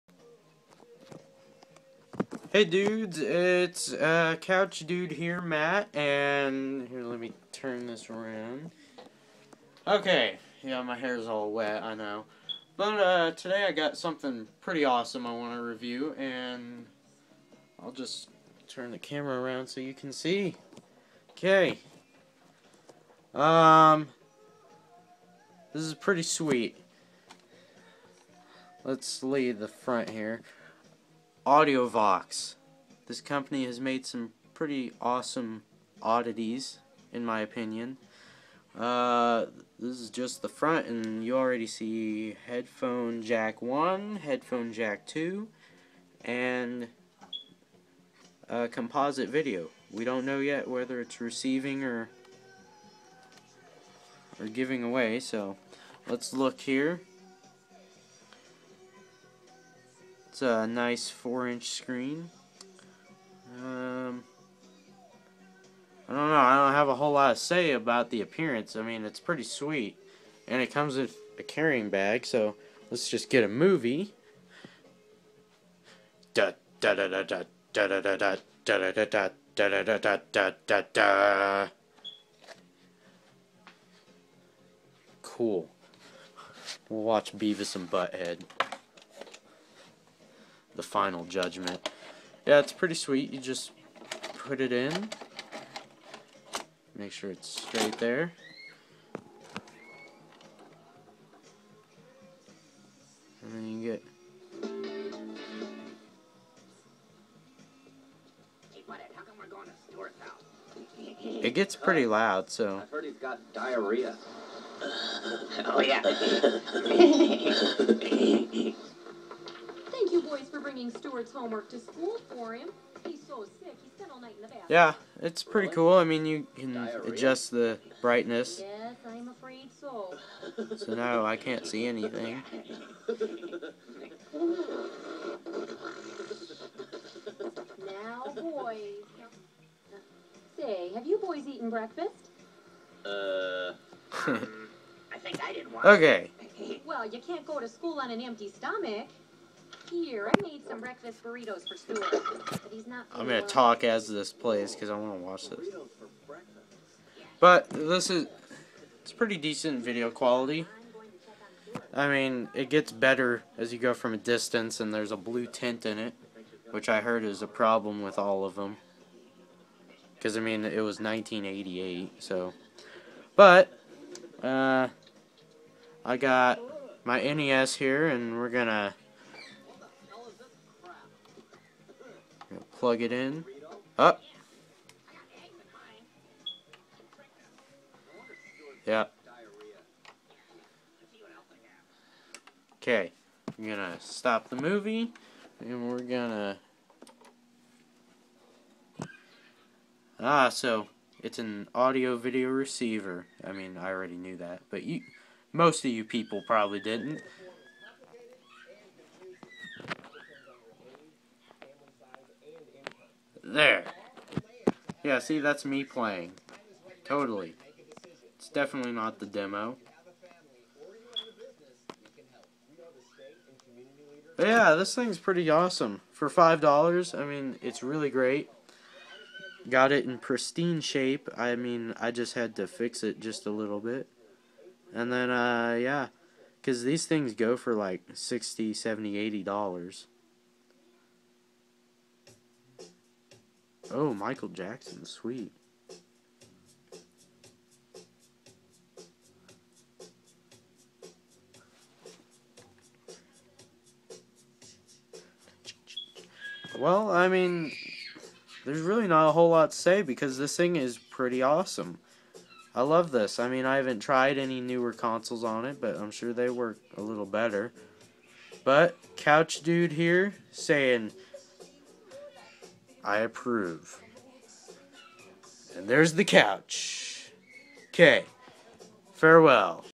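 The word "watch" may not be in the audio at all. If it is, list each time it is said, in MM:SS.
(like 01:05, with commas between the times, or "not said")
01:27, 02:35.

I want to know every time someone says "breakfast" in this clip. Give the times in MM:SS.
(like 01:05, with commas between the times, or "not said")
02:21, 02:30.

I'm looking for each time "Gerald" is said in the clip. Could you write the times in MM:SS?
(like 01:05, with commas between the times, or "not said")
not said.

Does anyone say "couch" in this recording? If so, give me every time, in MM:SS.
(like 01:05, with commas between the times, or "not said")
00:04, 04:29, 04:36.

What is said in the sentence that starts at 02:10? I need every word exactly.
So now I can't see anything.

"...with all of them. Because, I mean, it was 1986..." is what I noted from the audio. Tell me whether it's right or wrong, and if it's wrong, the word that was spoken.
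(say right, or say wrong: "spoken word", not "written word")
wrong: "1988", not "1986".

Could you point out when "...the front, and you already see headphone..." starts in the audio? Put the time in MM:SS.
00:40.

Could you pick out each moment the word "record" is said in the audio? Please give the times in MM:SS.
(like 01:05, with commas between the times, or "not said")
not said.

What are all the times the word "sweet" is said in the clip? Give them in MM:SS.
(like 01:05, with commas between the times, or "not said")
00:26, 01:09, 01:32, 04:05.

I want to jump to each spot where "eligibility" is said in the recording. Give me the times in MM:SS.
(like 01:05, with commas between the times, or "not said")
not said.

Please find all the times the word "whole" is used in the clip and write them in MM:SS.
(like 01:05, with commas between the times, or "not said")
01:06, 04:19.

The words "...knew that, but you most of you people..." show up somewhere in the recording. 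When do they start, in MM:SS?
03:24.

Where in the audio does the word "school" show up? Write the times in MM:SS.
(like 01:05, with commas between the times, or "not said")
02:01, 02:27.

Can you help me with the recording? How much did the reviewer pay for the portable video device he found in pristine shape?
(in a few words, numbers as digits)
$5.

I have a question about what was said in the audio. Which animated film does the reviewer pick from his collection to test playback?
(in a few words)
Beavis and Butthead.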